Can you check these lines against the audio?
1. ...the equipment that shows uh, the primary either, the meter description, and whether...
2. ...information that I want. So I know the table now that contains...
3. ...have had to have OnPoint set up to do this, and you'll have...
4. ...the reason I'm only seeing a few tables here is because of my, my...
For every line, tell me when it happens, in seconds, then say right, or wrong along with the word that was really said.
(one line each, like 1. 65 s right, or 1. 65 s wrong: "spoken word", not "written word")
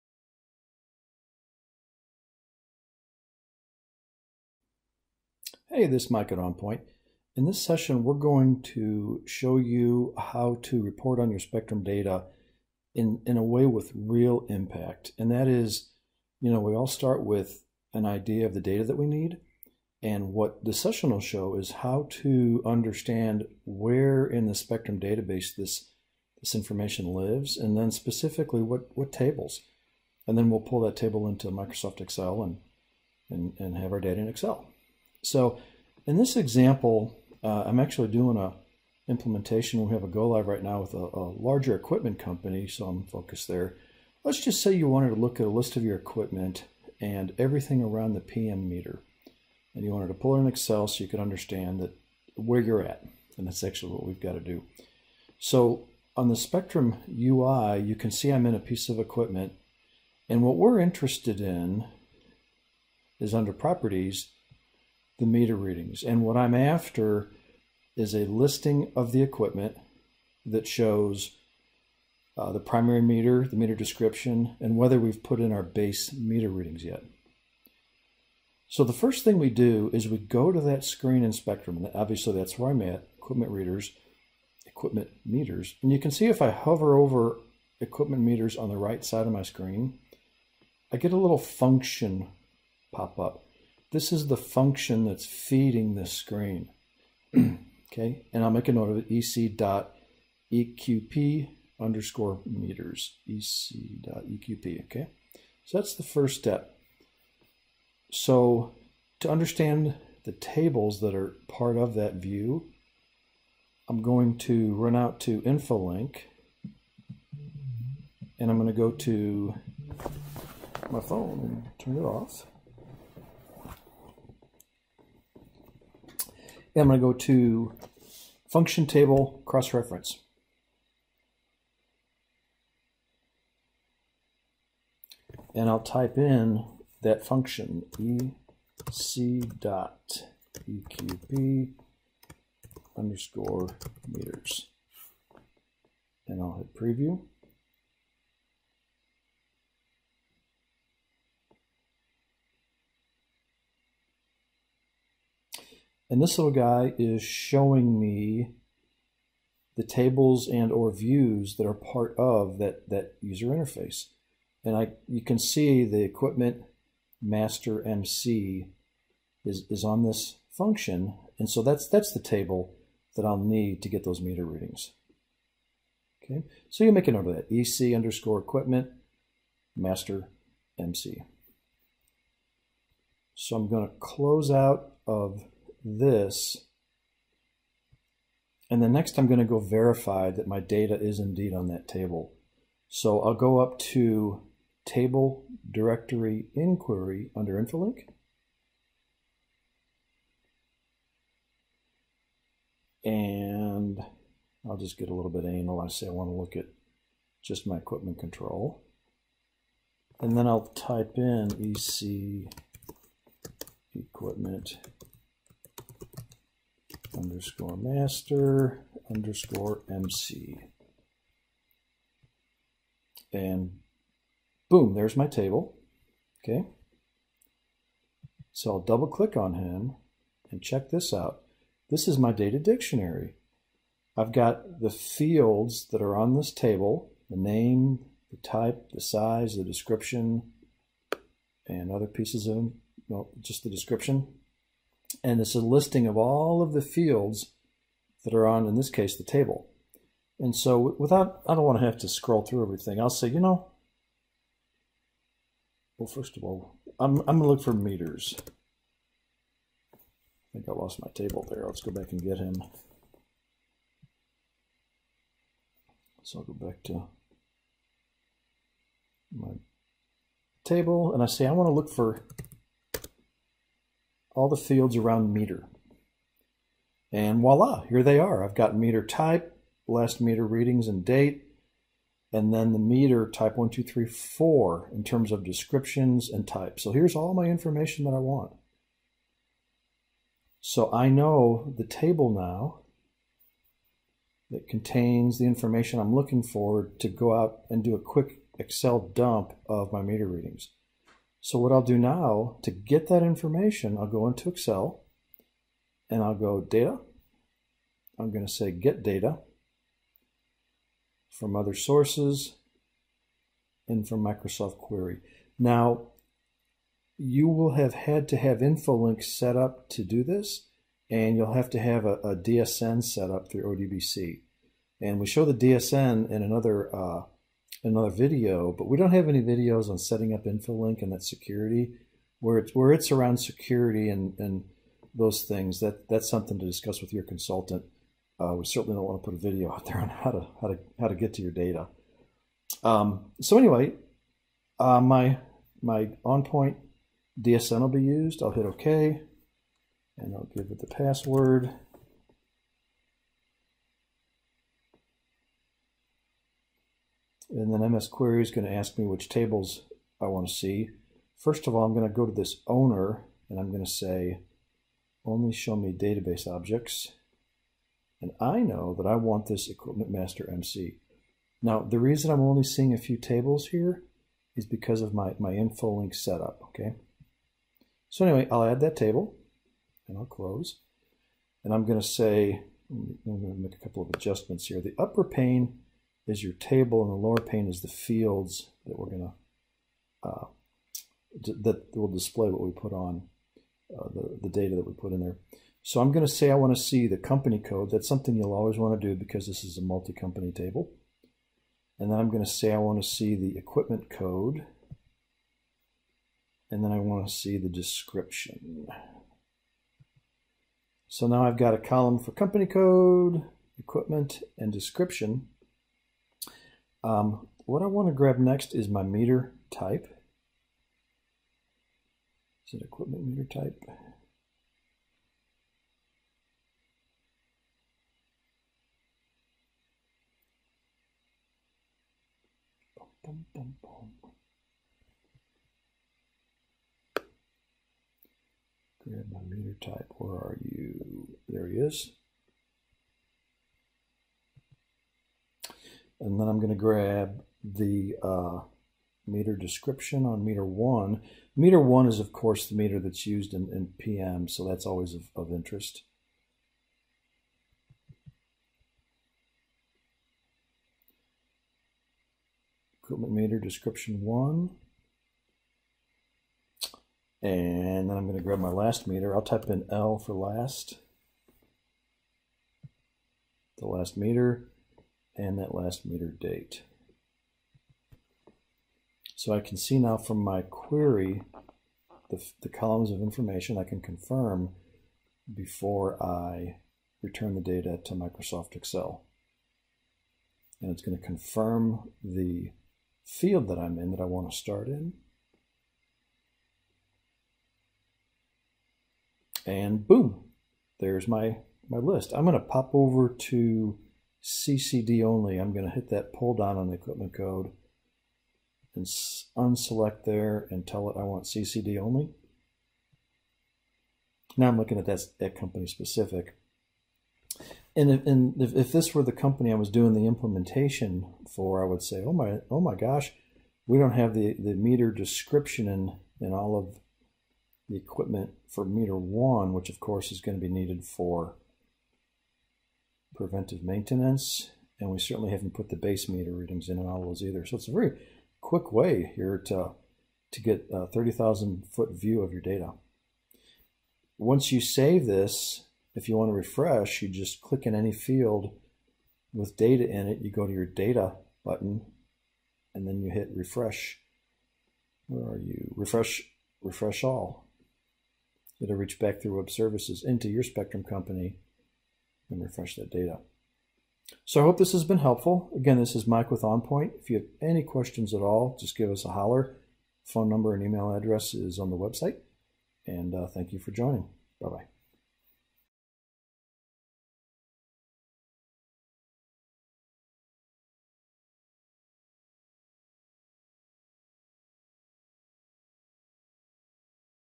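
1. 69 s wrong: "meter", not "either"
2. 287 s right
3. 317 s wrong: "Infolink", not "OnPoint"
4. 371 s right.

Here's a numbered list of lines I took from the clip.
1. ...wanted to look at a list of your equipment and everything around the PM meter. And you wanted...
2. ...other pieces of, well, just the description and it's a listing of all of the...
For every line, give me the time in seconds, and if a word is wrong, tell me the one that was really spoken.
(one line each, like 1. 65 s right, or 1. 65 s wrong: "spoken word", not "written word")
1. 44 s right
2. 241 s right.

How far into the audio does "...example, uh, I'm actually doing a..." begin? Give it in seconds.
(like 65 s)
36 s.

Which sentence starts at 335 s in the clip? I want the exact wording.
That that's something to discuss with your consultant.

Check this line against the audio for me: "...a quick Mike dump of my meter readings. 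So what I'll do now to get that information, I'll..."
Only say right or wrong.
wrong.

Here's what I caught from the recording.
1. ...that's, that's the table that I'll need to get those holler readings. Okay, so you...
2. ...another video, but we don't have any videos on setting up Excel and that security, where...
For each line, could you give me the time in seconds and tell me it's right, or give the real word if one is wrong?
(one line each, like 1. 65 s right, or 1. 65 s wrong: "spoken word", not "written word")
1. 171 s wrong: "meter", not "holler"
2. 327 s wrong: "InfoLink", not "Excel".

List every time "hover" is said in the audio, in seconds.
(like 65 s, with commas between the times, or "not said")
86 s.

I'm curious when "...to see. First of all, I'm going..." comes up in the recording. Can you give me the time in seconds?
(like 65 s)
360 s.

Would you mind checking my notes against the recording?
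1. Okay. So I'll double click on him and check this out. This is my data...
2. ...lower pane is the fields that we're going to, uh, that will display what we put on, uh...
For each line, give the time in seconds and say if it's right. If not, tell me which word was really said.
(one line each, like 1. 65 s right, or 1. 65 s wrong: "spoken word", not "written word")
1. 226 s right
2. 387 s right.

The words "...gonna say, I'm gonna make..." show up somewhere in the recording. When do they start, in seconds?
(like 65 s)
381 s.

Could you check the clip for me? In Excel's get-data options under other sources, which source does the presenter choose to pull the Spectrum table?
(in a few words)
Microsoft Query.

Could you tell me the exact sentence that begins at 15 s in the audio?
And that is, you know, we all start with an idea of the data that we need.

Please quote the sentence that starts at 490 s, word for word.
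And it's going to confirm the field that I'm in that I want to start in.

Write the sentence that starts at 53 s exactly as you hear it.
And that's actually what we've got to do.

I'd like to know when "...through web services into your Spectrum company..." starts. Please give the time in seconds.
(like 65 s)
559 s.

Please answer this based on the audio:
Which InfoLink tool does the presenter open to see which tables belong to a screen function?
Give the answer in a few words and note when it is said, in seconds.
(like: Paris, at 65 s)
function table cross-reference, at 128 s.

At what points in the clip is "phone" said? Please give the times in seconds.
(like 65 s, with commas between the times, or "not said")
121 s, 570 s.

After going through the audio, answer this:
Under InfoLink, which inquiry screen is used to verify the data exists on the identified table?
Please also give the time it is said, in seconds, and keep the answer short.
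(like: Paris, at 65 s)
Table Directory Inquiry, at 194 s.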